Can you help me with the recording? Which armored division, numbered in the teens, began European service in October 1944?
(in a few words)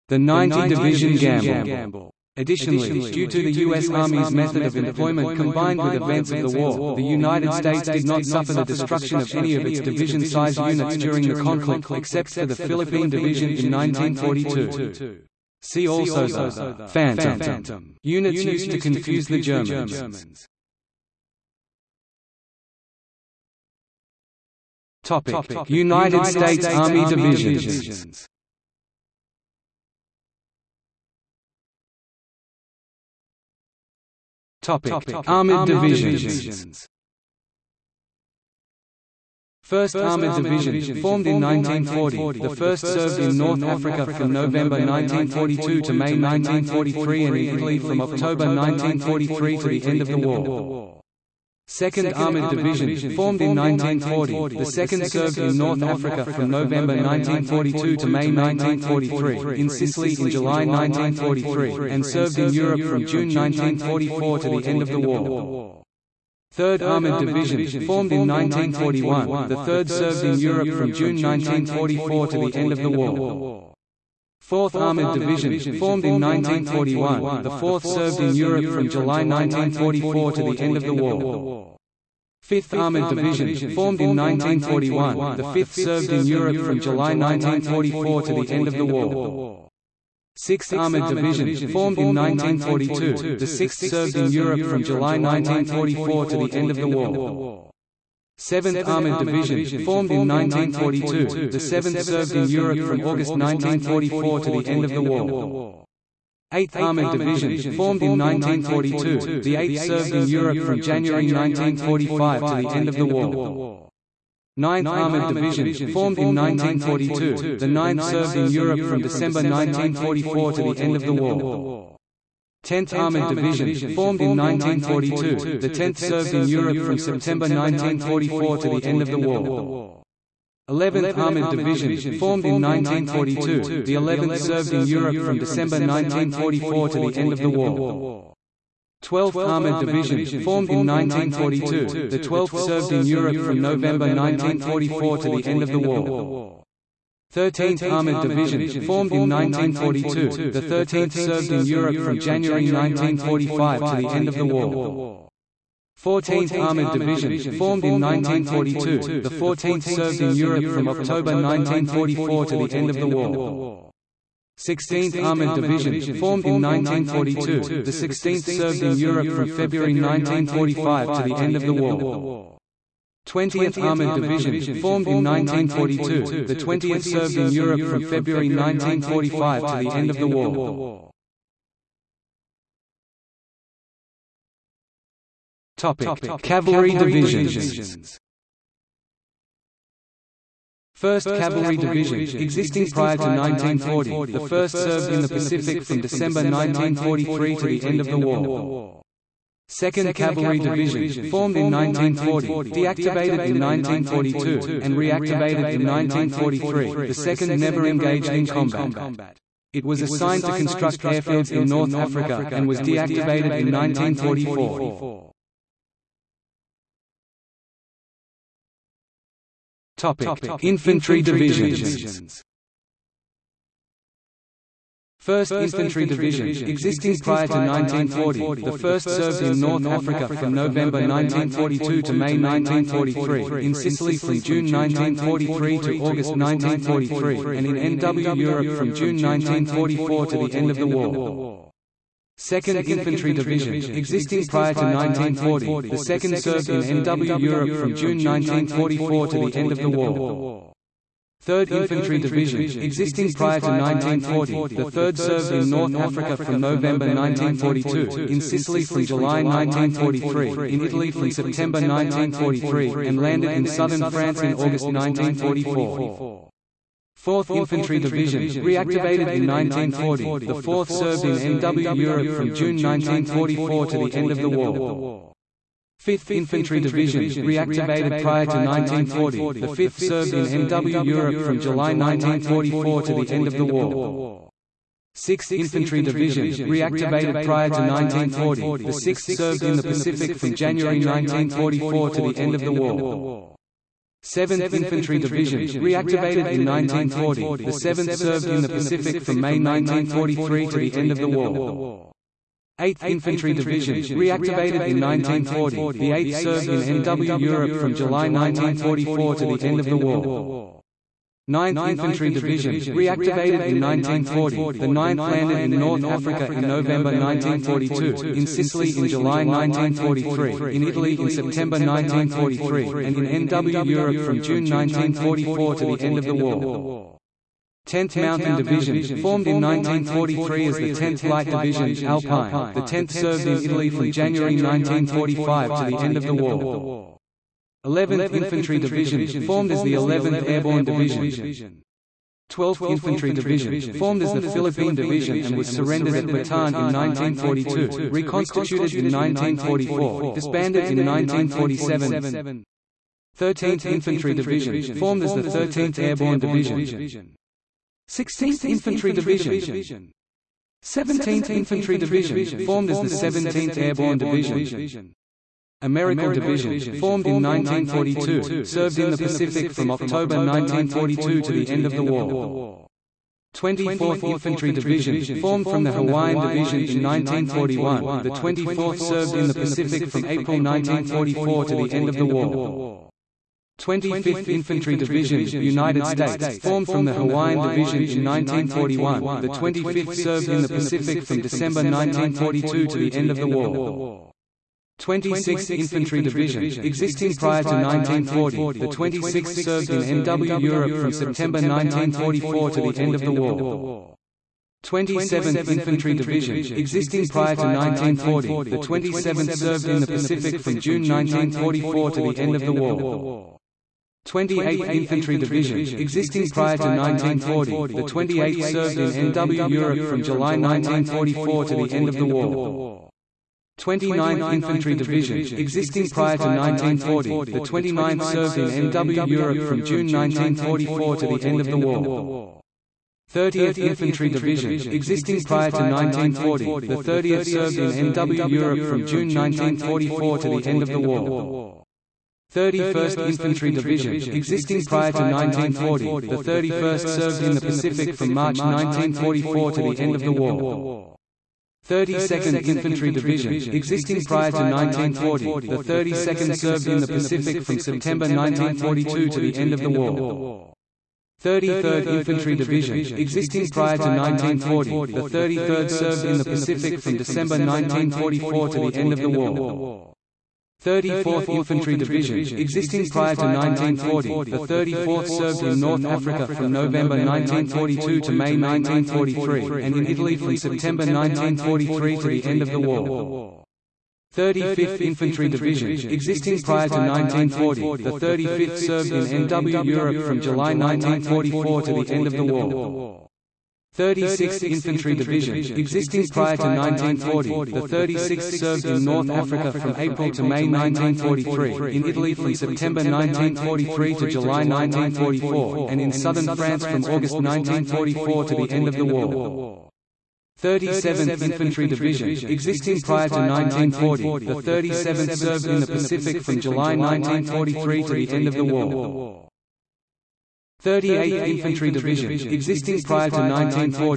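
14th Armoured Division.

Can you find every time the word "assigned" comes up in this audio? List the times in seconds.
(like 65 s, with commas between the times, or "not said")
210 s.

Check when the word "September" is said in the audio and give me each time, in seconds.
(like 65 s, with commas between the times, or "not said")
126 s, 261 s, 321 s, 401 s, 457 s, 480 s, 502 s.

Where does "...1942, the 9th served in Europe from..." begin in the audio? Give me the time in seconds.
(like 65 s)
116 s.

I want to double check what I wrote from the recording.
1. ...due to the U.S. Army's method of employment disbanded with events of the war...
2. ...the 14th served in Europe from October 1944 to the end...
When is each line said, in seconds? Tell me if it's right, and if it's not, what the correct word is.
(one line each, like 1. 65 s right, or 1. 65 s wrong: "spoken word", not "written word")
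1. 3 s wrong: "combined", not "disbanded"
2. 159 s right.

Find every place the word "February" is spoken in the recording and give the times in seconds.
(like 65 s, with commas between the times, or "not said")
169 s, 178 s.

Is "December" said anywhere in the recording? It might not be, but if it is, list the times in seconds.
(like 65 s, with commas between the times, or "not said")
119 s, 135 s, 195 s, 391 s, 467 s.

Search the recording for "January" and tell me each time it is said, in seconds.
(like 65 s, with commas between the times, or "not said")
110 s, 152 s, 290 s, 334 s.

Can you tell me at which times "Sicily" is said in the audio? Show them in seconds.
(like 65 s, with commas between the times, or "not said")
59 s, 233 s, 258 s, 318 s.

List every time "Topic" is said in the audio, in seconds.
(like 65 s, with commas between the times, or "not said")
34 s, 185 s, 219 s.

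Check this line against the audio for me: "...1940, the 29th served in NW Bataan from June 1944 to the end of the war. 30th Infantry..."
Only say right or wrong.
wrong.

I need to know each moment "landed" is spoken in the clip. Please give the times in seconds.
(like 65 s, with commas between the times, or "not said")
263 s, 315 s.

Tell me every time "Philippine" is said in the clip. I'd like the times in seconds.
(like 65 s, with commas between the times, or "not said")
12 s, 344 s.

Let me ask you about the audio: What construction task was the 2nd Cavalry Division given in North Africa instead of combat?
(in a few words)
Construct airfields.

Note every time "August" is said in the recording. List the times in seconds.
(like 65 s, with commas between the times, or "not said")
103 s, 235 s, 264 s, 507 s.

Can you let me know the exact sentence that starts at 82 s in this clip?
5th Armored Division, formed in 1941, the 5th served in Europe from July 1944 to the end of the war.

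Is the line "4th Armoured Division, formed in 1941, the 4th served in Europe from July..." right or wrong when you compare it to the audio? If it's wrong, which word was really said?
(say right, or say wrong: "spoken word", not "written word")
right.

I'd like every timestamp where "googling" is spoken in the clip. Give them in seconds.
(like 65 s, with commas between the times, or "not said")
not said.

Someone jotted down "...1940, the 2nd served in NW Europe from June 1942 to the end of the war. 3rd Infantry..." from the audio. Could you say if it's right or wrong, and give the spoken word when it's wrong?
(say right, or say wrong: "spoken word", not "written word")
wrong: "1944", not "1942".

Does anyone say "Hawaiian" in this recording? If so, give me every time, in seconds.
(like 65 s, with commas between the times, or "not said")
375 s, 387 s.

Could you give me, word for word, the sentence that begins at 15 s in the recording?
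See also the «phantom» units used to confuse the Germans.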